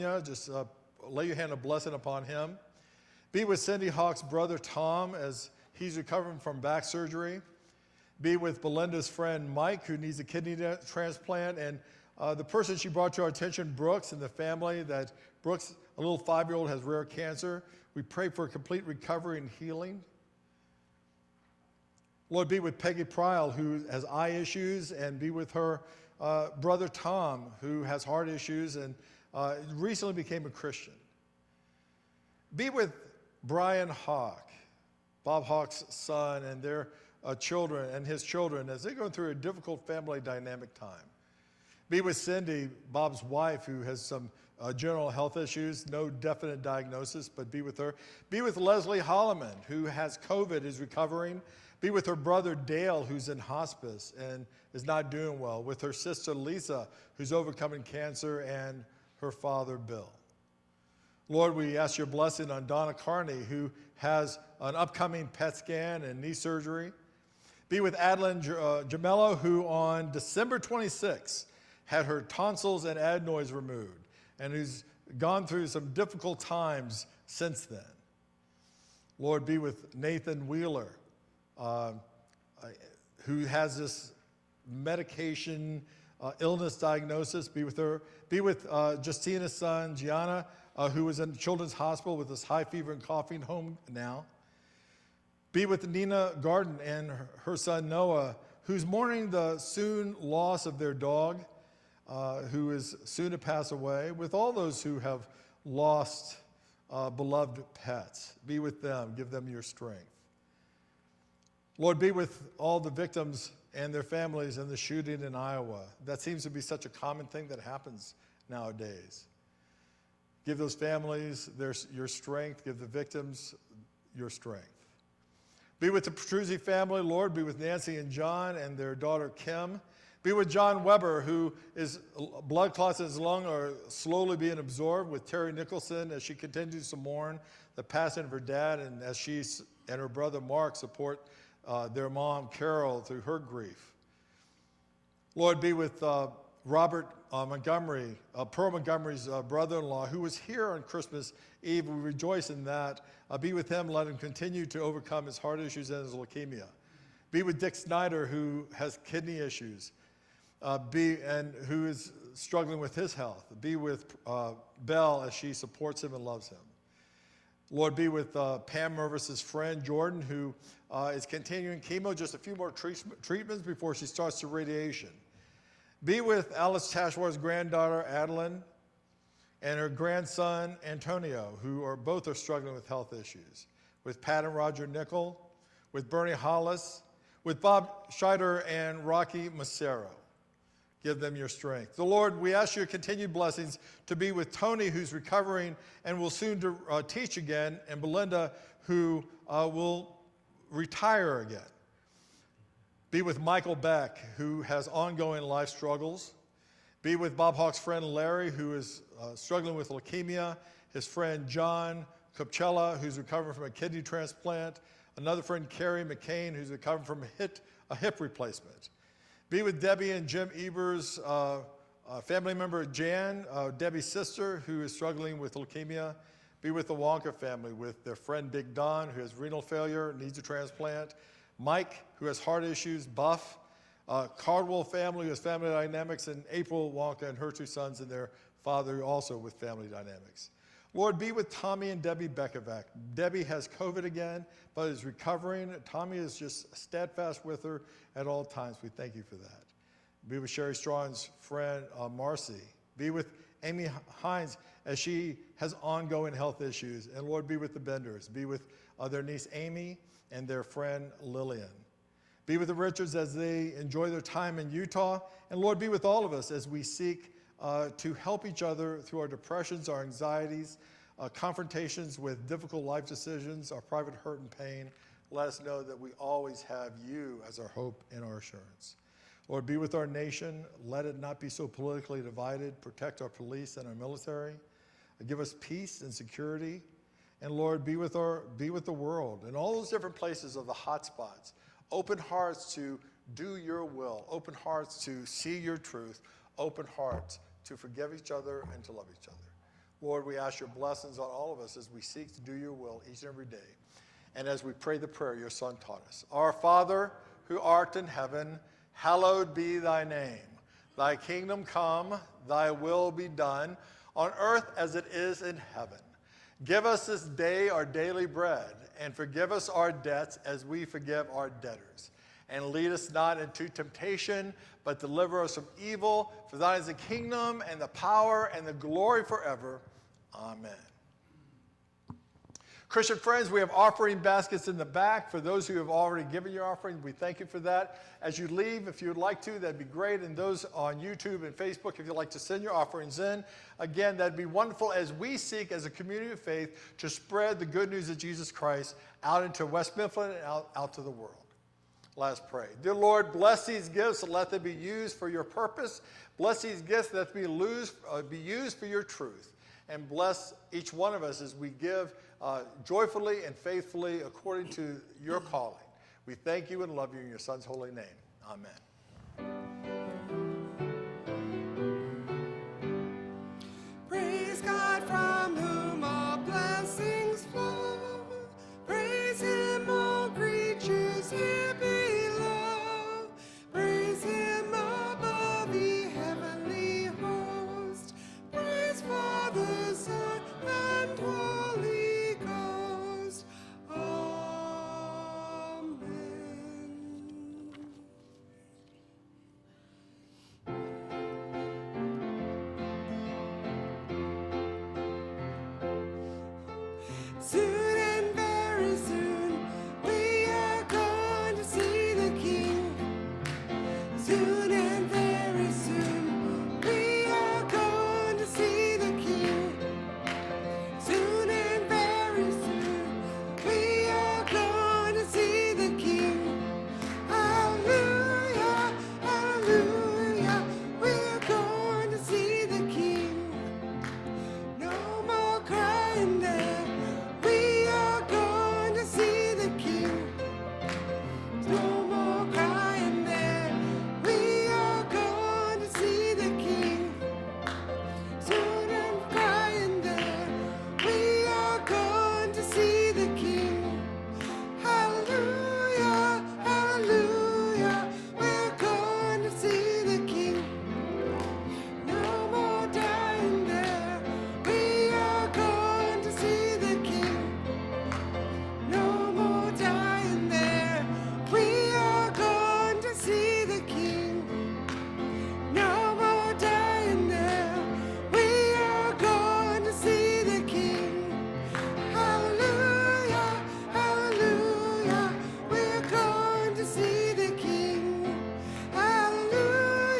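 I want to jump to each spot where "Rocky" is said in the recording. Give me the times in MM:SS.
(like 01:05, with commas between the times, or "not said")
03:09.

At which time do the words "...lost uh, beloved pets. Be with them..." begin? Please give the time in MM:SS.
01:45.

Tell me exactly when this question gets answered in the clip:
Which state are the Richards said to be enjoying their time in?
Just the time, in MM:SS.
04:24.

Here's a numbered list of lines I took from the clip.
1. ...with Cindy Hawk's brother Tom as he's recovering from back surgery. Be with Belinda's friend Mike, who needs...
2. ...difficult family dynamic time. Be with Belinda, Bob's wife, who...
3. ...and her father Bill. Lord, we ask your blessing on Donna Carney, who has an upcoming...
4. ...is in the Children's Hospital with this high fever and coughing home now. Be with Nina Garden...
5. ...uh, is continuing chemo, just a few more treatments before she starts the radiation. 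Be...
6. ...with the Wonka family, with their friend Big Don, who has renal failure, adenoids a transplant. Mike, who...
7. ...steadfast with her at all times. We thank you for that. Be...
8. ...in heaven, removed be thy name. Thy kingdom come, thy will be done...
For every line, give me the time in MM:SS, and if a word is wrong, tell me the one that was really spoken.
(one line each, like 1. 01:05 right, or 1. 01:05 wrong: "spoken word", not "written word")
1. 00:03 right
2. 00:39 wrong: "Cindy", not "Belinda"
3. 00:58 right
4. 01:31 right
5. 02:50 right
6. 03:46 wrong: "needs", not "adenoids"
7. 04:06 right
8. 05:07 wrong: "hallowed", not "removed".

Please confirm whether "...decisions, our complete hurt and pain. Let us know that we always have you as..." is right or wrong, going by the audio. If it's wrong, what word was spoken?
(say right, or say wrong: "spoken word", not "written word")
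wrong: "private", not "complete".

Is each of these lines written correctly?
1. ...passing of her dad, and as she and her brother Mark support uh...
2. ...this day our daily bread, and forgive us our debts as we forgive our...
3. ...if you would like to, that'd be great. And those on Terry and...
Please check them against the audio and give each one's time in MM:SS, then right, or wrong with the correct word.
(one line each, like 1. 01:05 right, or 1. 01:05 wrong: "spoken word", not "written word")
1. 02:17 right
2. 05:17 right
3. 05:38 wrong: "YouTube", not "Terry".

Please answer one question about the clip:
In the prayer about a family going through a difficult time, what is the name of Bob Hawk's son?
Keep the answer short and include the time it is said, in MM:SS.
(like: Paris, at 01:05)
Brian, at 00:33.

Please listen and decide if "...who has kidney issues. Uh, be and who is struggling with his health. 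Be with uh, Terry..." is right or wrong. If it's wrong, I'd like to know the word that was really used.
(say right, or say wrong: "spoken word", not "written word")
wrong: "Belle", not "Terry".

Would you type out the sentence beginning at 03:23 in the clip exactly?
Be with Michael Beck, who has ongoing life struggles.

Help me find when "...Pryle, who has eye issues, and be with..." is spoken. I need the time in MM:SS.
00:23.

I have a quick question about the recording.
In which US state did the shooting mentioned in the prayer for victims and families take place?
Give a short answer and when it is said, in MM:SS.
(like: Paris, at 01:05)
Iowa, at 01:55.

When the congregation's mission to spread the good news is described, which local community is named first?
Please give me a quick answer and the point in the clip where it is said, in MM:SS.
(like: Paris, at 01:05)
West Mifflin, at 05:49.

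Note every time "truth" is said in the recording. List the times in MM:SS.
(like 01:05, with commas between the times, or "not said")
04:55, 05:59.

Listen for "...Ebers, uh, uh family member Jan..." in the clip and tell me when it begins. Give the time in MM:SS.
03:40.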